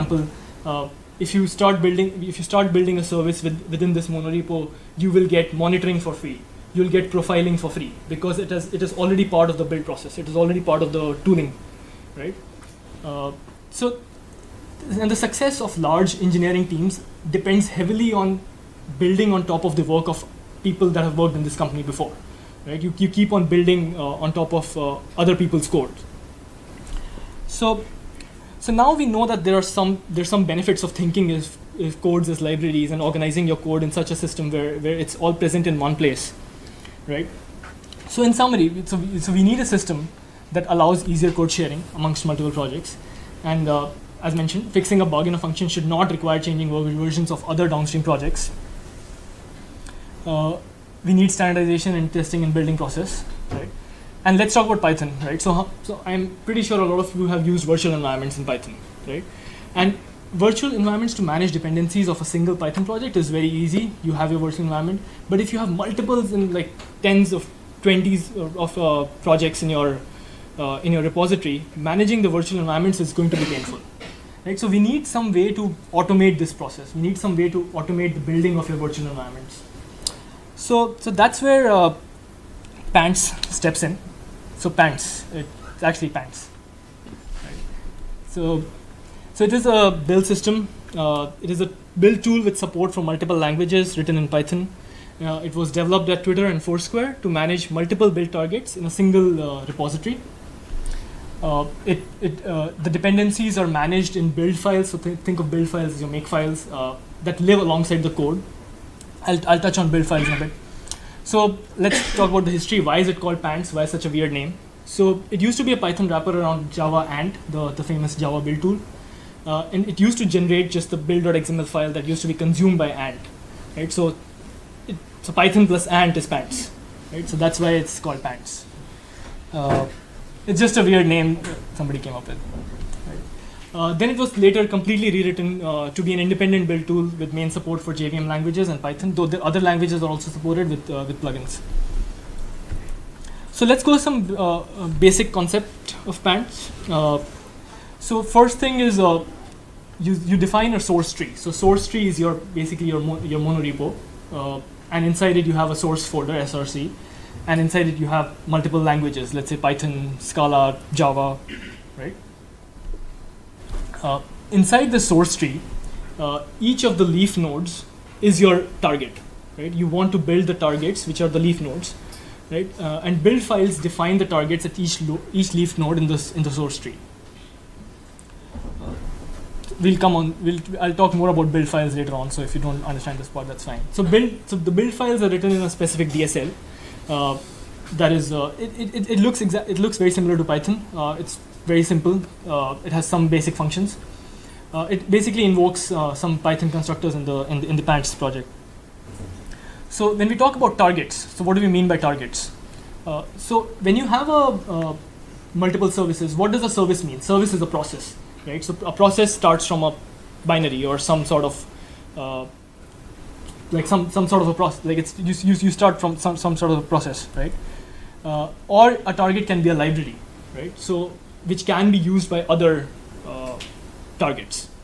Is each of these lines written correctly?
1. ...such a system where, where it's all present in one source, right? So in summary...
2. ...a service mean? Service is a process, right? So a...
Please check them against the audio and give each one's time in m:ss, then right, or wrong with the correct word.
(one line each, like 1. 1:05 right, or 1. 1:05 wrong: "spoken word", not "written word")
1. 0:33 wrong: "place", not "source"
2. 3:26 right.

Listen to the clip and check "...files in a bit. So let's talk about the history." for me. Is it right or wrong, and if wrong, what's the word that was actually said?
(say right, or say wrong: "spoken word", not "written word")
right.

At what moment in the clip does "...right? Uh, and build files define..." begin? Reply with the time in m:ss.
2:52.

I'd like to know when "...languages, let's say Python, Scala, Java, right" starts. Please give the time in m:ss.
2:38.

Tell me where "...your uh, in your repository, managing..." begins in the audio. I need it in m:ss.
1:09.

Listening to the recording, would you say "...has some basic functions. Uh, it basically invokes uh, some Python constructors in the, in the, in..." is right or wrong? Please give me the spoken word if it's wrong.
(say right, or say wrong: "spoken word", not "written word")
right.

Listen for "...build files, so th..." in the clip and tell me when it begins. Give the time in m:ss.
1:44.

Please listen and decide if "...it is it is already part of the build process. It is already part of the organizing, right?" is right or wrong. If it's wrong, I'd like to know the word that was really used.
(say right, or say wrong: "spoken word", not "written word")
wrong: "tuning", not "organizing".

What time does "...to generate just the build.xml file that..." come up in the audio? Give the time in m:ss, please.
2:00.